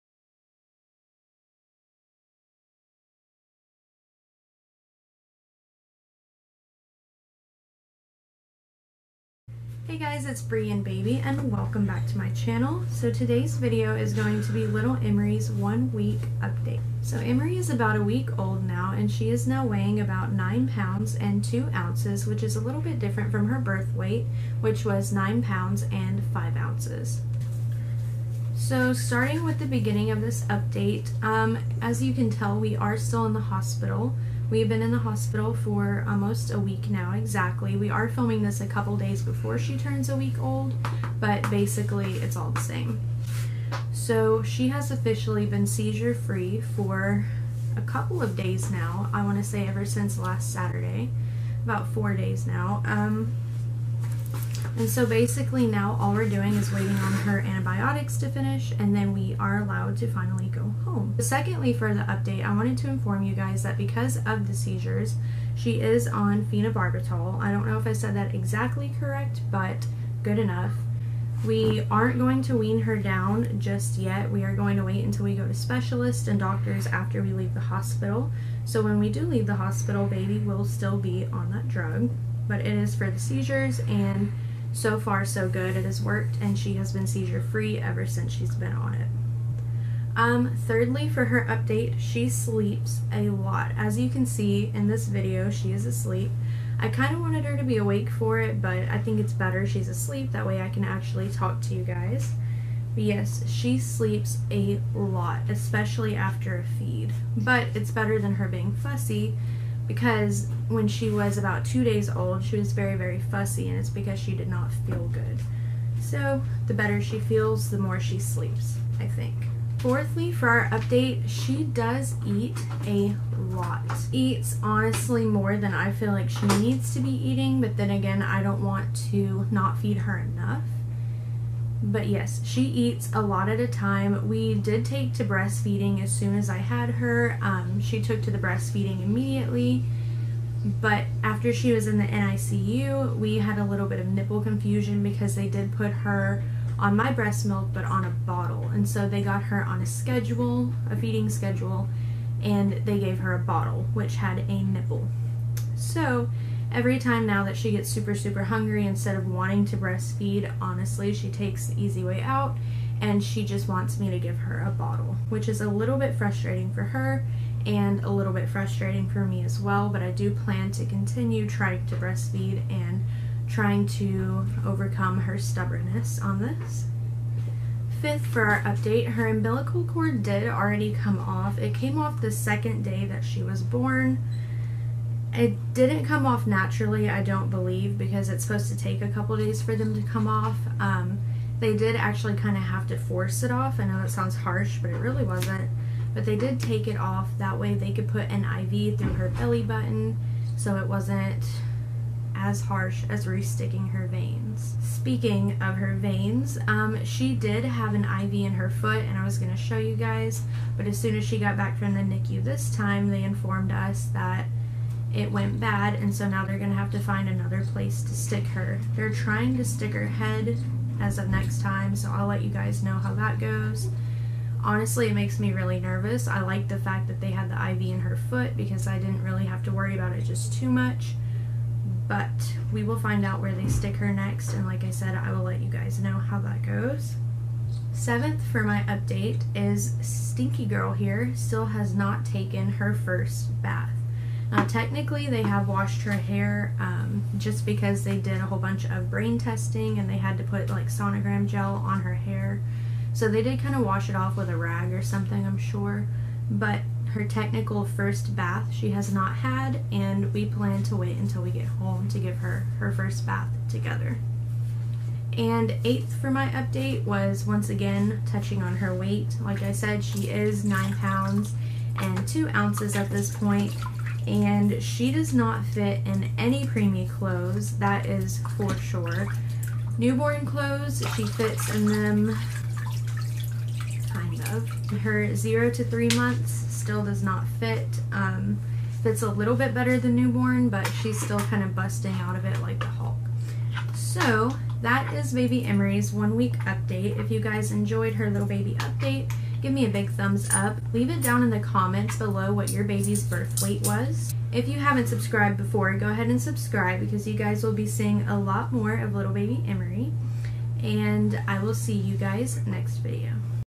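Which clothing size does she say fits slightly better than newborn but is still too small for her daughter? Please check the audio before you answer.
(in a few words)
0 to 3 months.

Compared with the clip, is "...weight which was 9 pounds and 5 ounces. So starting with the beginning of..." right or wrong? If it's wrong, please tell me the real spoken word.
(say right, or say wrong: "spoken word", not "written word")
right.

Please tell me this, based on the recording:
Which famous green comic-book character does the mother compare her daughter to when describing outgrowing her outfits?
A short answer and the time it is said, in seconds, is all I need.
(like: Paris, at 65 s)
The Hulk, at 292 s.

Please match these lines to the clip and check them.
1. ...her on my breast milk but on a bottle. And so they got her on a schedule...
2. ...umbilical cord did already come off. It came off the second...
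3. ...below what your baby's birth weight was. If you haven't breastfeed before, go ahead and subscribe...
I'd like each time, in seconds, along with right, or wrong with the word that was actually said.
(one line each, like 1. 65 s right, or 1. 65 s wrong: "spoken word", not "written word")
1. 145 s right
2. 179 s right
3. 302 s wrong: "subscribed", not "breastfeed".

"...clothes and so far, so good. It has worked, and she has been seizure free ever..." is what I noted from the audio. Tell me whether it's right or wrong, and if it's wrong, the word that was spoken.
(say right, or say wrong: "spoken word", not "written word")
wrong: "seizures", not "clothes".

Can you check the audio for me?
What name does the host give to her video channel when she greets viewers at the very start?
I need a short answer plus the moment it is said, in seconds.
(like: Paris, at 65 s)
Bree and Baby, at 10 s.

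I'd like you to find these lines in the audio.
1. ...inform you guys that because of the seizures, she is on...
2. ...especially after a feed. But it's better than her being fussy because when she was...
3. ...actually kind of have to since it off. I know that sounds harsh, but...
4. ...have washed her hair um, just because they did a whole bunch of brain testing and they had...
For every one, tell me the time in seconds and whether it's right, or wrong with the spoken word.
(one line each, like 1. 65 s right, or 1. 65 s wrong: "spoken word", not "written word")
1. 62 s right
2. 105 s right
3. 191 s wrong: "force", not "since"
4. 245 s right.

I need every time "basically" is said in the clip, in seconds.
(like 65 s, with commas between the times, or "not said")
41 s, 55 s.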